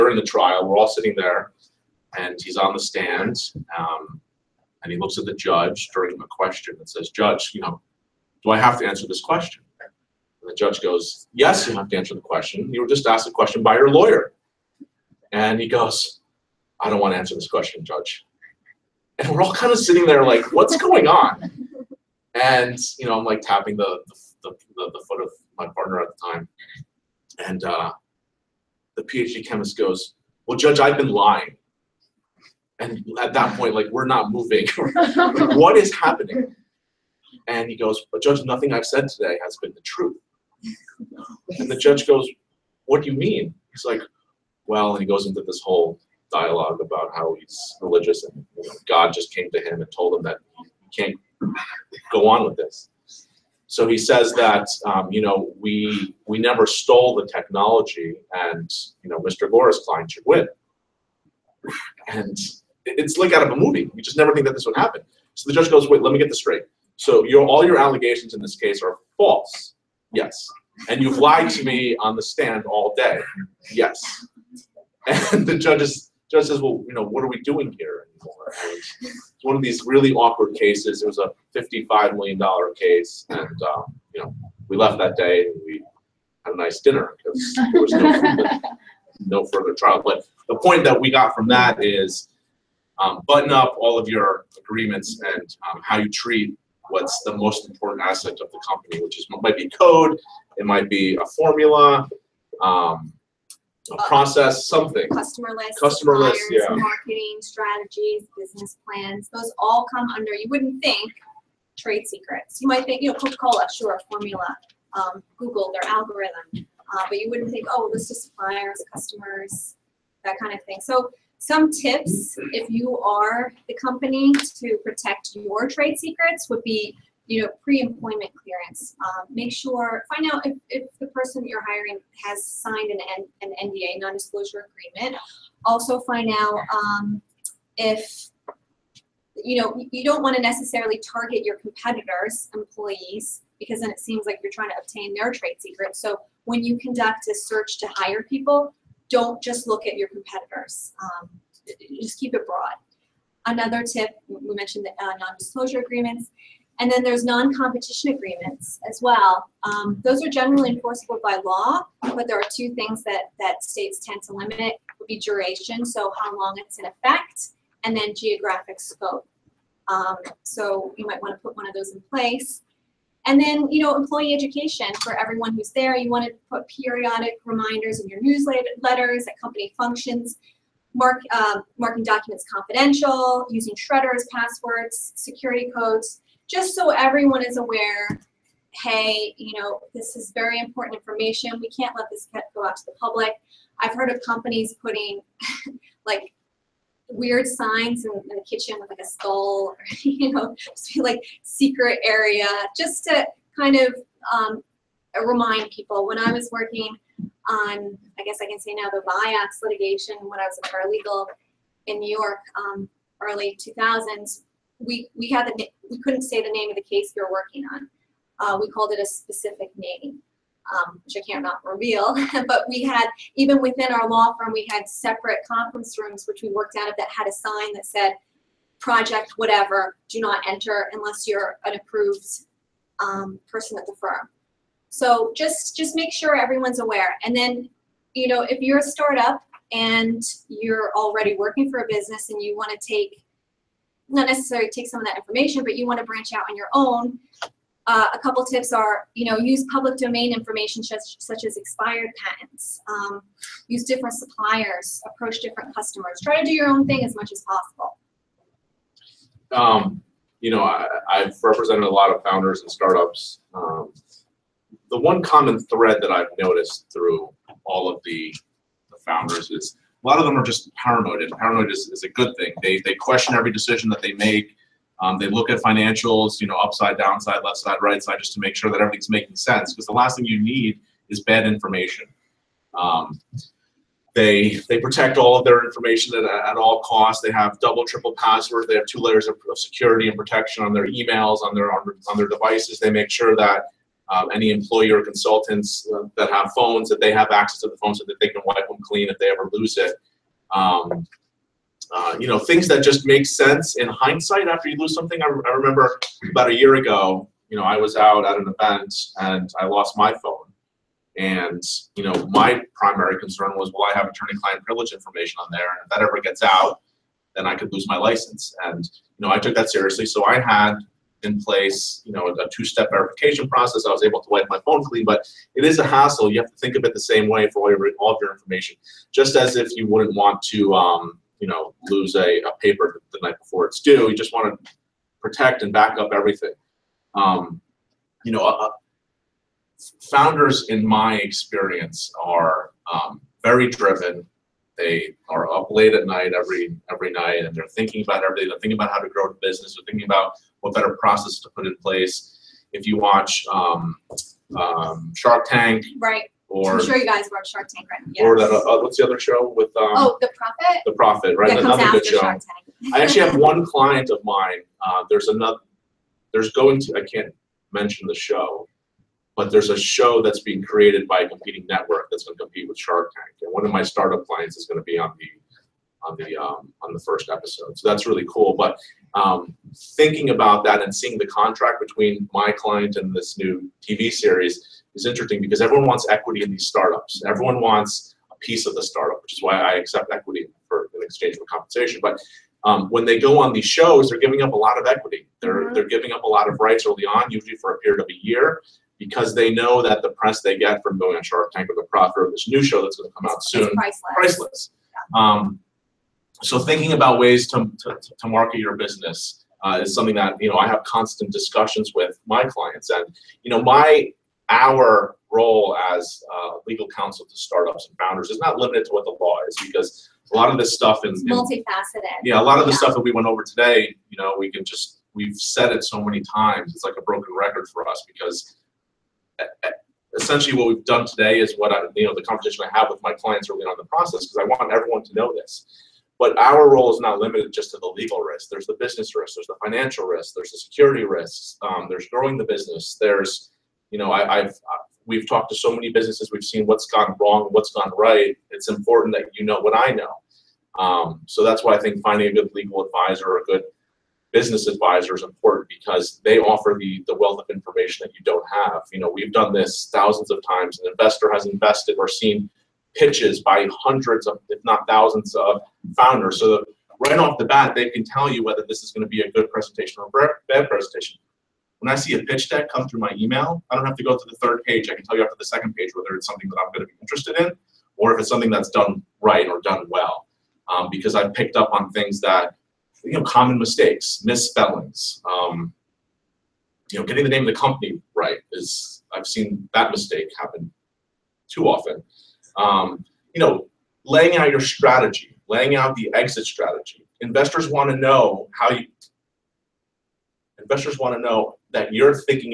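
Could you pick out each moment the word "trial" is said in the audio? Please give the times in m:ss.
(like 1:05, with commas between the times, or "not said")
0:00, 1:29.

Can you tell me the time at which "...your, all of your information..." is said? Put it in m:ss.
5:27.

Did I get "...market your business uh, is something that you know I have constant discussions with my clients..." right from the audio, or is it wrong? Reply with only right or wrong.
right.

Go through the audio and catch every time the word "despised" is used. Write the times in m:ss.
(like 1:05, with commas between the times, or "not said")
not said.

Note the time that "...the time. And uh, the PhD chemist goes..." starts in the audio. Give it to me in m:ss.
0:26.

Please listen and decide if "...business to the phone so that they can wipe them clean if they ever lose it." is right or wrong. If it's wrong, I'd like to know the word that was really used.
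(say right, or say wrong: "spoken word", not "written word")
wrong: "access", not "business".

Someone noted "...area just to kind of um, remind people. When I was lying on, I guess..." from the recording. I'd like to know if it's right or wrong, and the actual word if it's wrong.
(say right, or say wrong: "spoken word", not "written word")
wrong: "working", not "lying".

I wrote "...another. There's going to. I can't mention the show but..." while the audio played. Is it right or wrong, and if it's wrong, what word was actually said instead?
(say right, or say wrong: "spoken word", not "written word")
right.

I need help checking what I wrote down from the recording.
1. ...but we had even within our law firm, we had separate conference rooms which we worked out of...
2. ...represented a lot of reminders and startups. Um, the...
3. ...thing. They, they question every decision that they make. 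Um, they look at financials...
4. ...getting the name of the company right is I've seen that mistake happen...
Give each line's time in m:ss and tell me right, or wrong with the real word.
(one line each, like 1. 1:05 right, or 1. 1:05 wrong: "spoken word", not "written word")
1. 3:42 right
2. 4:21 wrong: "founders", not "reminders"
3. 4:32 right
4. 8:07 right.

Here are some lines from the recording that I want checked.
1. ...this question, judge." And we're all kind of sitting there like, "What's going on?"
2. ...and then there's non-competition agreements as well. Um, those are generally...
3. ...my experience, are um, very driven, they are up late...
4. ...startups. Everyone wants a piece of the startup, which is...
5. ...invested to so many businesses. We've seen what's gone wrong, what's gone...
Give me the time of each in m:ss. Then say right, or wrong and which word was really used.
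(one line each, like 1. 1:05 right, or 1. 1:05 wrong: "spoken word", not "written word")
1. 0:17 right
2. 2:36 right
3. 5:40 right
4. 6:26 right
5. 7:25 wrong: "talked", not "invested".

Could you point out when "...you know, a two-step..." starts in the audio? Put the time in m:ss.
5:22.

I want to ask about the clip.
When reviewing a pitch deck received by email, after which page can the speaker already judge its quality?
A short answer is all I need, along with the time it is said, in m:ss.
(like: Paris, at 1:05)
second page, at 7:55.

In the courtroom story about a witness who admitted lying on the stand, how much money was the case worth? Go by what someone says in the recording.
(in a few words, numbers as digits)
$55 million.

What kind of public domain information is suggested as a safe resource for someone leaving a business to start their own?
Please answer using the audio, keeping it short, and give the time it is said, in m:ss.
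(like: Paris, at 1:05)
expired patents, at 4:11.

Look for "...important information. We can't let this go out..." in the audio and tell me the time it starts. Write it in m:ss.
3:10.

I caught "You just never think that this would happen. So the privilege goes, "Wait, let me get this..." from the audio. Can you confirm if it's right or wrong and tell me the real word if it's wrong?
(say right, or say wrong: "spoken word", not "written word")
wrong: "judge", not "privilege".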